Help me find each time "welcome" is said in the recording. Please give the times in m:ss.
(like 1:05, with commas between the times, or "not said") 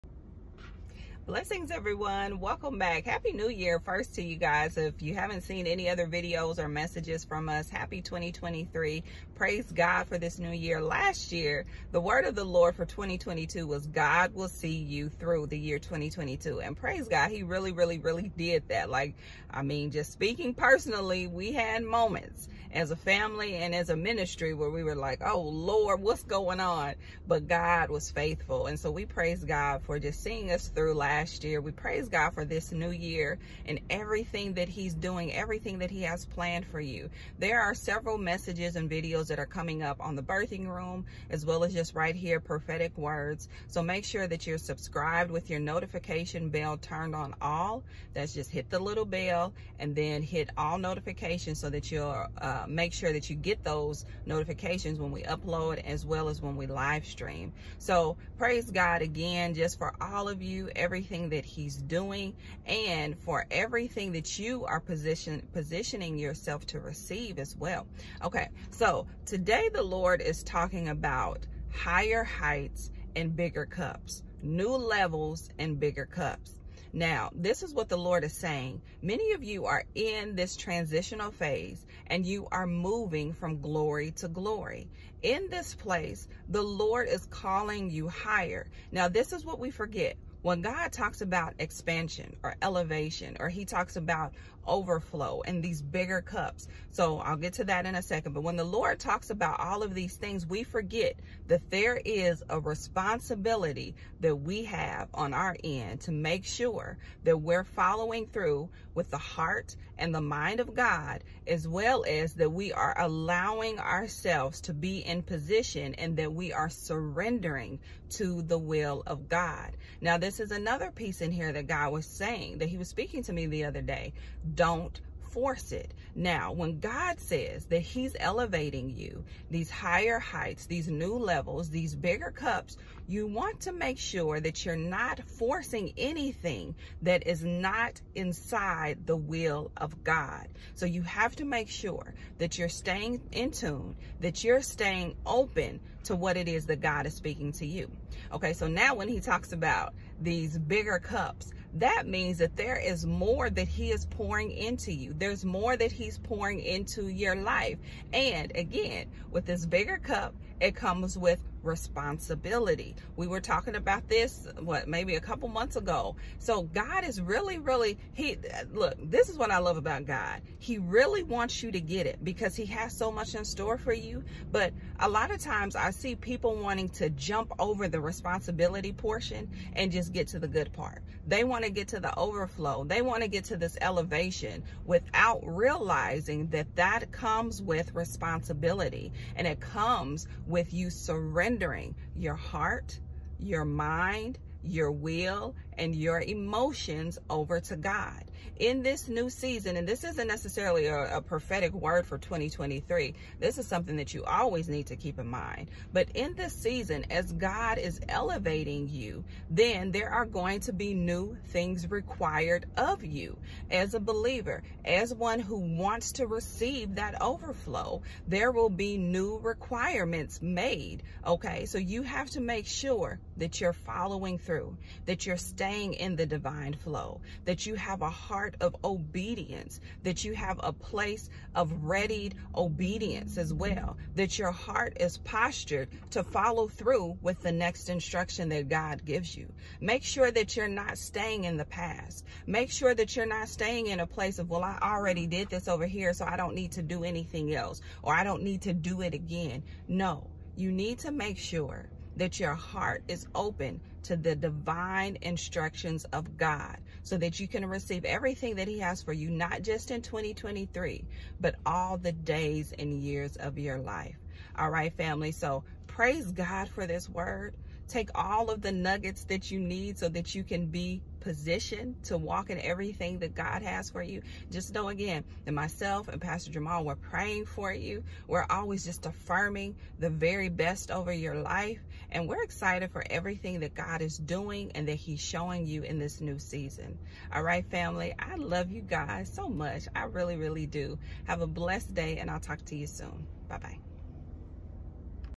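0:02.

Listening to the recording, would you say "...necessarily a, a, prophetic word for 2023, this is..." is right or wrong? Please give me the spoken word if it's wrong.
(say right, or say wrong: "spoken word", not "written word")
right.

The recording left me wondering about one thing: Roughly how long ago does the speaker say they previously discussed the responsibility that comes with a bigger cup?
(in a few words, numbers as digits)
A couple months ago.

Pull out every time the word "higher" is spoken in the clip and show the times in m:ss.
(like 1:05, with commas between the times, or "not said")
1:11, 1:28, 2:09.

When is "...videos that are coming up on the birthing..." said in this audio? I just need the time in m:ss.
0:38.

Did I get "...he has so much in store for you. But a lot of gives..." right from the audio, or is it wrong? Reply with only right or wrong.
wrong.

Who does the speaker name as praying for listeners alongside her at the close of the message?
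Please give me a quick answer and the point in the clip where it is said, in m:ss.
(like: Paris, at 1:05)
Pastor Jamal, at 4:36.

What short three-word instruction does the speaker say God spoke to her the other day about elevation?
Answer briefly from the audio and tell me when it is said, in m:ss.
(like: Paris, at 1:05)
Don't force it, at 2:04.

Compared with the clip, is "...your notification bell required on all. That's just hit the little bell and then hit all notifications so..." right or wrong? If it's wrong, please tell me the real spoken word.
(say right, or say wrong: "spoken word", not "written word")
wrong: "turned", not "required".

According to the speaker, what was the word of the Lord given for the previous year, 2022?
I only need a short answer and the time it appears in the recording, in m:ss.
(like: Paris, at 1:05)
God will see you through, at 0:13.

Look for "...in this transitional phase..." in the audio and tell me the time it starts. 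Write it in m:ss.
1:19.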